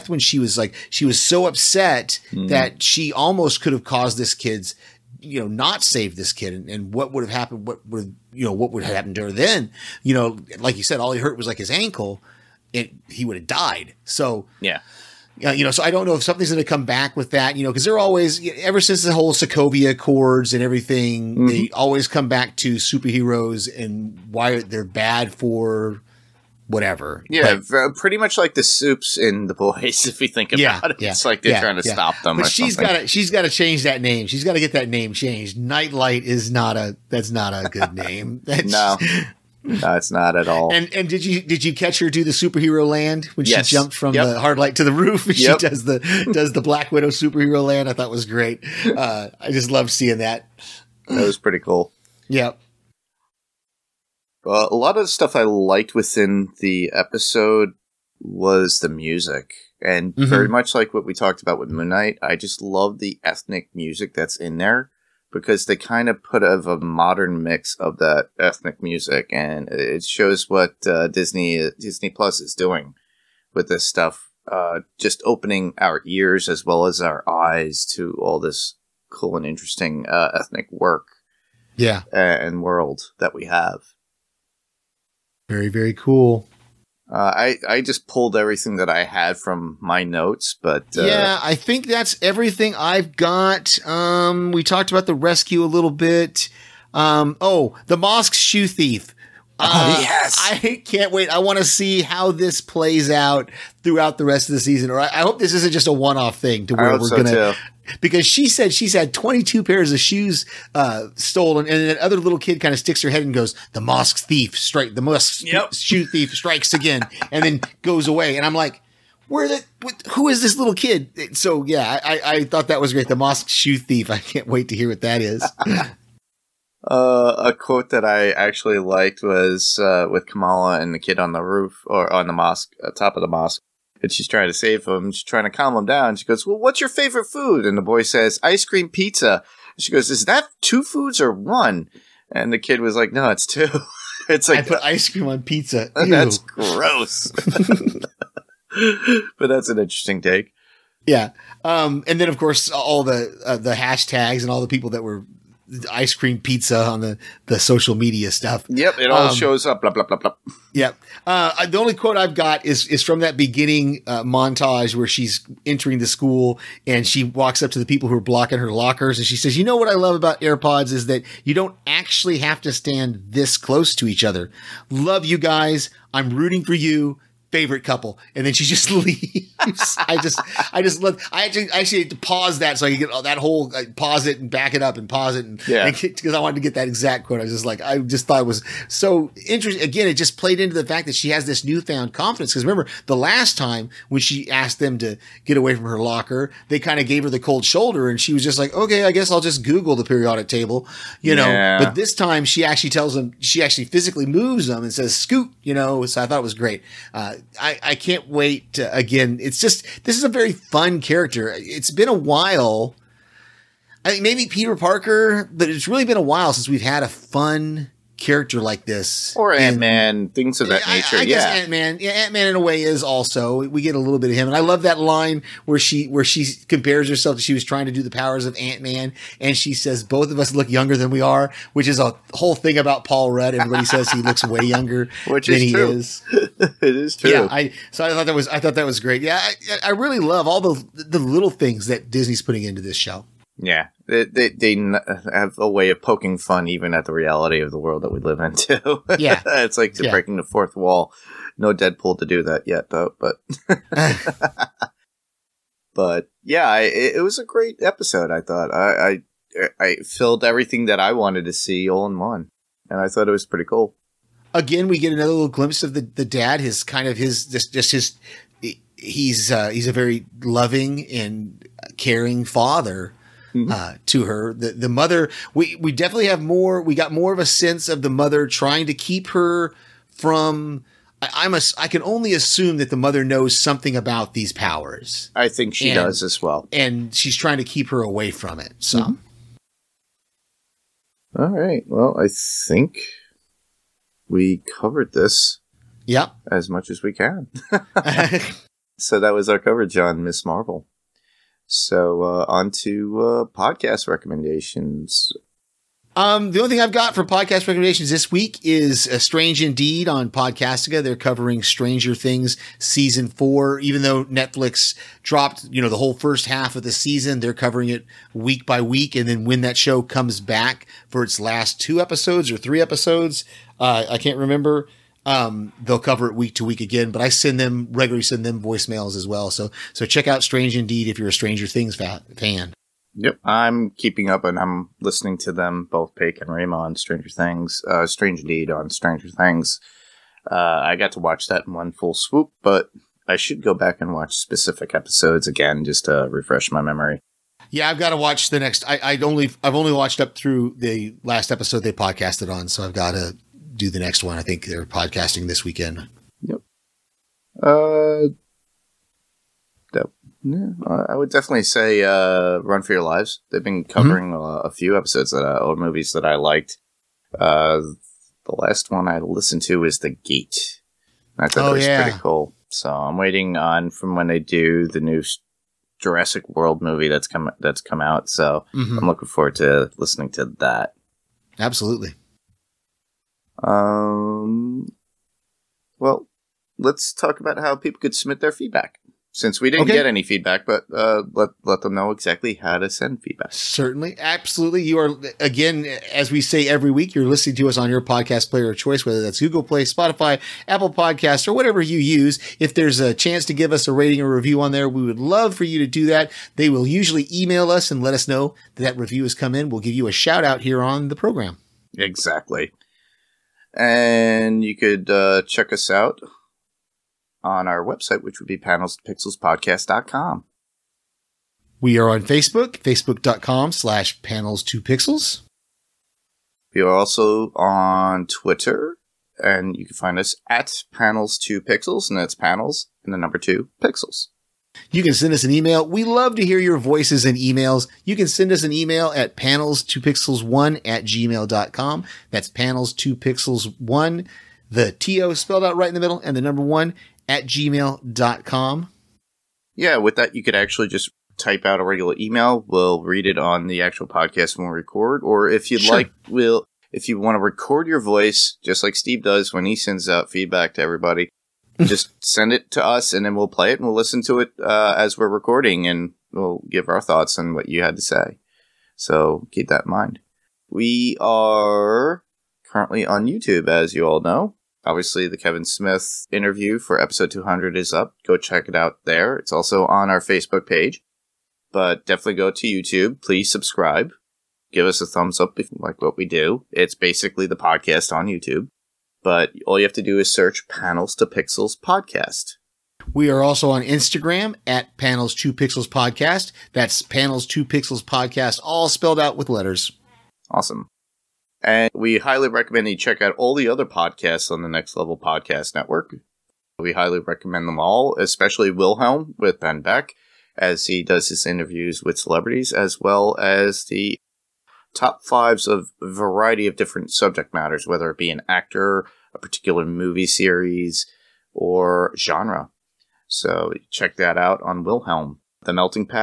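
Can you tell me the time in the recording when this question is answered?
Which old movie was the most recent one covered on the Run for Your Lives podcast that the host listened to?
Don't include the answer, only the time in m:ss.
6:09.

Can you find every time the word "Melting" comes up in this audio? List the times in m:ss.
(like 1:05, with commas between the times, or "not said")
8:45.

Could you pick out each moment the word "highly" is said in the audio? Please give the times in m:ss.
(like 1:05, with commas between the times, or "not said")
8:22, 8:26.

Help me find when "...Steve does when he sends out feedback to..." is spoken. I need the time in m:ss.
7:38.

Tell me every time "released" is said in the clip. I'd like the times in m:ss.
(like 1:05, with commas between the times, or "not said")
not said.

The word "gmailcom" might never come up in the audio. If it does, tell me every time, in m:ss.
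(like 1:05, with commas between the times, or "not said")
7:21, 7:27.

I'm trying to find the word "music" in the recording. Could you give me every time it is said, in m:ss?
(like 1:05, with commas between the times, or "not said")
0:58, 1:03, 1:08.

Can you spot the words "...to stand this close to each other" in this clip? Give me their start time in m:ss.
2:52.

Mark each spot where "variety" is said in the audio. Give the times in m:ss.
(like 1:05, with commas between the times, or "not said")
8:36.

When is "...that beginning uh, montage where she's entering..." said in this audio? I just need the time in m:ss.
2:43.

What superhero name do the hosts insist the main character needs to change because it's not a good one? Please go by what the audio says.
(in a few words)
Nightlight.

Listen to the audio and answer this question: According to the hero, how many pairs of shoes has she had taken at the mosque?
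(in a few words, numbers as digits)
22.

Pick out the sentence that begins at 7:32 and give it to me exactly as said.
We'll read it on the actual podcast when we record.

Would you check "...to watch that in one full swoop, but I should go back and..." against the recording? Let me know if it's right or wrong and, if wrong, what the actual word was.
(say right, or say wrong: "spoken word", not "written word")
right.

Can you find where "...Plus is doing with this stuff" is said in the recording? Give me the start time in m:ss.
1:12.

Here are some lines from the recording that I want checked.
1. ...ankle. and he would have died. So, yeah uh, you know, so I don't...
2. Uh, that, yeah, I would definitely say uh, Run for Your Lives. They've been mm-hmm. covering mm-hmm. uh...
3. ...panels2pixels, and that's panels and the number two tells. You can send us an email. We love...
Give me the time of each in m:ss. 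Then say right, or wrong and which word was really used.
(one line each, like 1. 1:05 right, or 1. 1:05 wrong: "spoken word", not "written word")
1. 0:11 right
2. 5:57 right
3. 7:10 wrong: "pixels", not "tells".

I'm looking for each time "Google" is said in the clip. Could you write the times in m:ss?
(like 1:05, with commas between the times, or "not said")
3:19, 6:39.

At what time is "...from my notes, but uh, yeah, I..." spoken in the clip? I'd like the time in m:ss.
1:29.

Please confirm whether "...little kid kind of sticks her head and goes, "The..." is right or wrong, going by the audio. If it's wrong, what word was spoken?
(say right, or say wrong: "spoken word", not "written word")
right.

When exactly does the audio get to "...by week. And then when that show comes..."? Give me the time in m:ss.
5:18.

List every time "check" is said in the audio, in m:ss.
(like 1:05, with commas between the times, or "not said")
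5:30, 6:55, 7:58, 8:22, 8:43.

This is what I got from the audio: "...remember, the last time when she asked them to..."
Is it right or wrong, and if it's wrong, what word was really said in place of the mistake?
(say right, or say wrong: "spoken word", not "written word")
right.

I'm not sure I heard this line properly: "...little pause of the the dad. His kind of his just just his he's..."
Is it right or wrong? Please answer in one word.
wrong.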